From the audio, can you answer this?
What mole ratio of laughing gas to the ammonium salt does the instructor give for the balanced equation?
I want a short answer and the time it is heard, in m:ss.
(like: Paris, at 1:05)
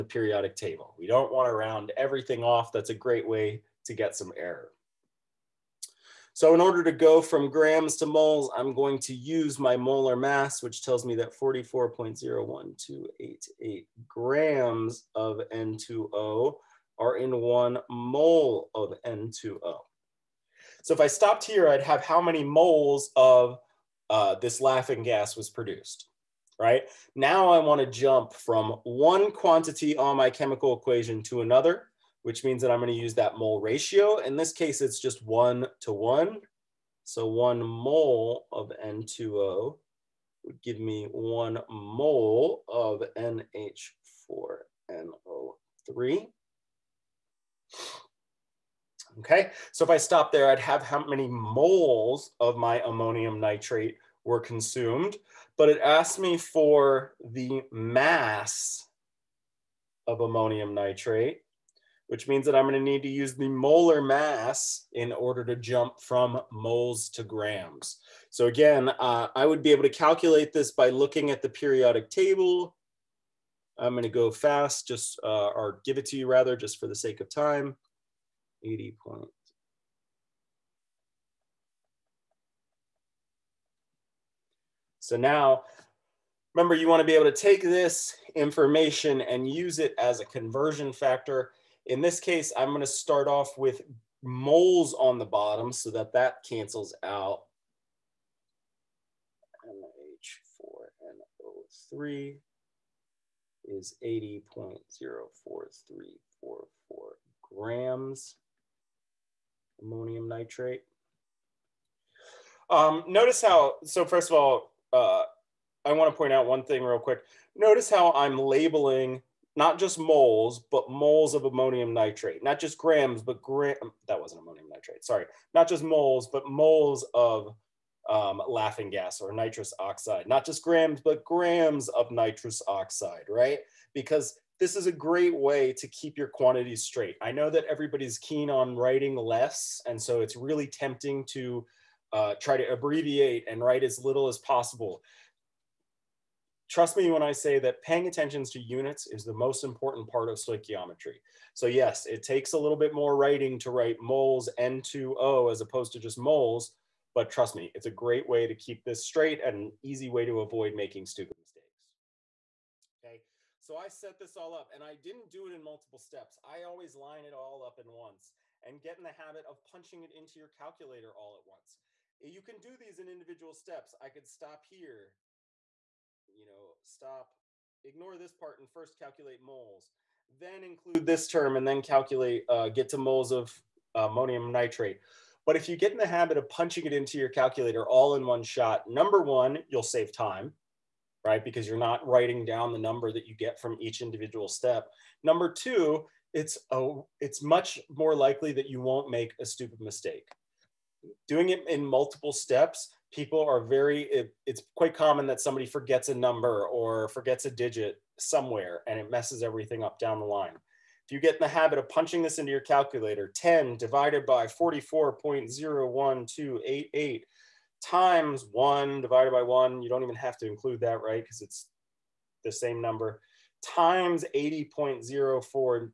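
one to one, at 0:35.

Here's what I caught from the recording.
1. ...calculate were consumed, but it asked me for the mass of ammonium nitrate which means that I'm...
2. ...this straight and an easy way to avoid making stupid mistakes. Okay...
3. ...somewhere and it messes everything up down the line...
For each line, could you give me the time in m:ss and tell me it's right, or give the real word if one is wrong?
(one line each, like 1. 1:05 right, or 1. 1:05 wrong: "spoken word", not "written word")
1. 0:53 wrong: "nitrate", not "calculate"
2. 2:38 right
3. 3:28 right.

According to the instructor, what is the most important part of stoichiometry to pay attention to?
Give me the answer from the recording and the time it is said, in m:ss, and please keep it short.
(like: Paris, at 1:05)
units, at 2:28.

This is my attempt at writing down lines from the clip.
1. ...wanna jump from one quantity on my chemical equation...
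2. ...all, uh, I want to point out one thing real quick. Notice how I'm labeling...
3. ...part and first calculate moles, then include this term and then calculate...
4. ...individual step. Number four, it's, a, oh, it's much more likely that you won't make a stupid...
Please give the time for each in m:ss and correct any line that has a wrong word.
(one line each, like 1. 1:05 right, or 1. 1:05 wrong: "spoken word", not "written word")
1. 0:27 right
2. 1:54 right
3. 2:58 right
4. 3:13 wrong: "two", not "four".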